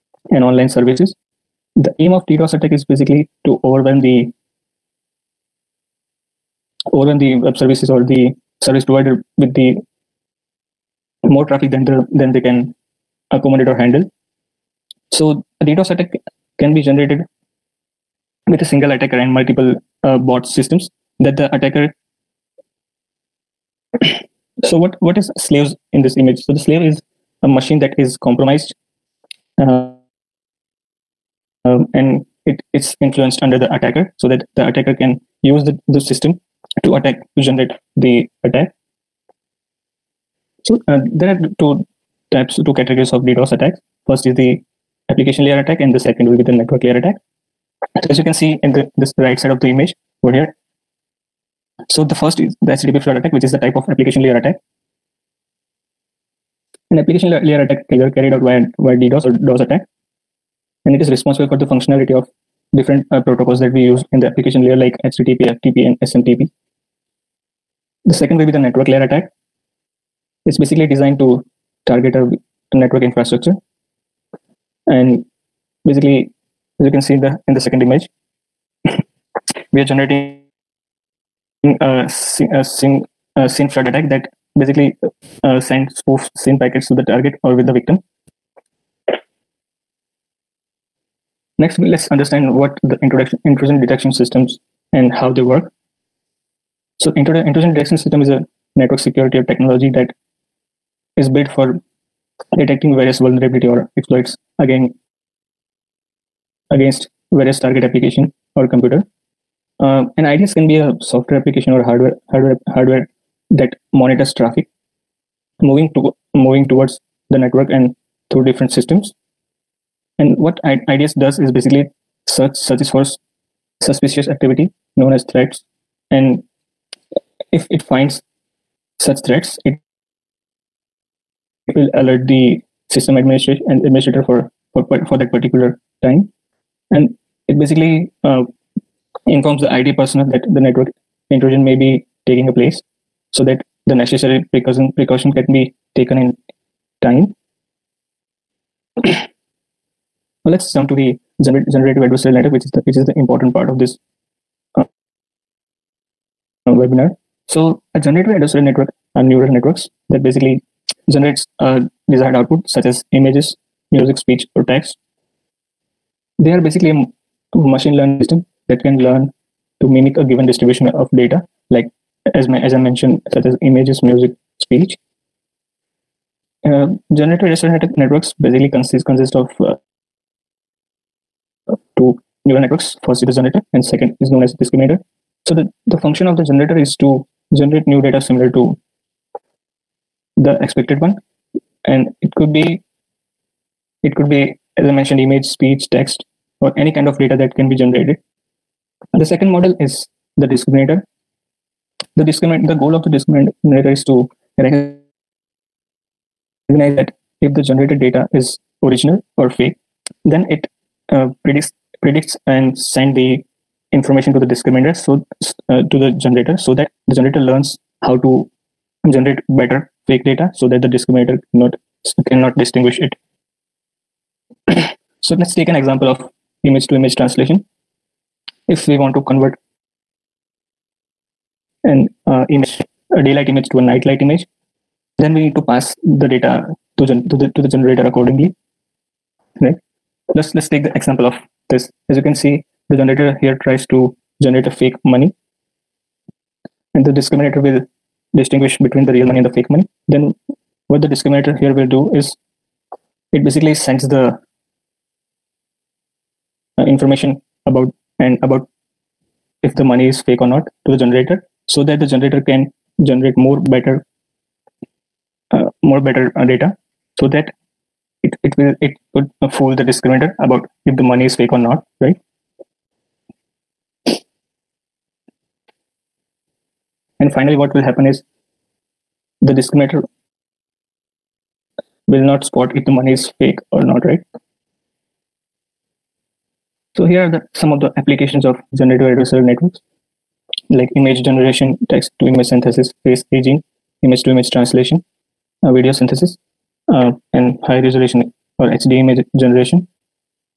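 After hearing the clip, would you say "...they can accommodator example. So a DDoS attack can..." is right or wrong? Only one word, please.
wrong.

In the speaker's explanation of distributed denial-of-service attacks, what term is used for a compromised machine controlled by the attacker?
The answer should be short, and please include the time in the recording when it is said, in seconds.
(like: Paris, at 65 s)
slave, at 26 s.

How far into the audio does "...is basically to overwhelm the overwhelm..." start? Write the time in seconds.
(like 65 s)
2 s.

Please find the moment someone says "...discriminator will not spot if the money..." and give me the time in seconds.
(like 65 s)
279 s.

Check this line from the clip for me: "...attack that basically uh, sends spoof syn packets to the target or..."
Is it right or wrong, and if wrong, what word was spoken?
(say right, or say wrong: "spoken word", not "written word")
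right.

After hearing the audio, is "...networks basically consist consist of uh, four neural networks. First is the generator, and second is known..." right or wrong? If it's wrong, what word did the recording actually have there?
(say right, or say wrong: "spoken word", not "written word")
wrong: "two", not "four".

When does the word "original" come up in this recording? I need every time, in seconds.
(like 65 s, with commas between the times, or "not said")
208 s.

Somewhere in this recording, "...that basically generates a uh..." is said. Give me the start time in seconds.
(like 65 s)
160 s.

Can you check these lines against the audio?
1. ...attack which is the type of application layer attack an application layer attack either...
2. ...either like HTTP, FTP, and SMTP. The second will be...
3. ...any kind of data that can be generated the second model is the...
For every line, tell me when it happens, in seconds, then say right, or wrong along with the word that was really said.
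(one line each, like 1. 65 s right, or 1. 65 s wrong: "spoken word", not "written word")
1. 53 s right
2. 64 s wrong: "layer", not "either"
3. 196 s right.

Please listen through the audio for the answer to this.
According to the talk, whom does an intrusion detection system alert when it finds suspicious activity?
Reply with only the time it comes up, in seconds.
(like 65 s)
132 s.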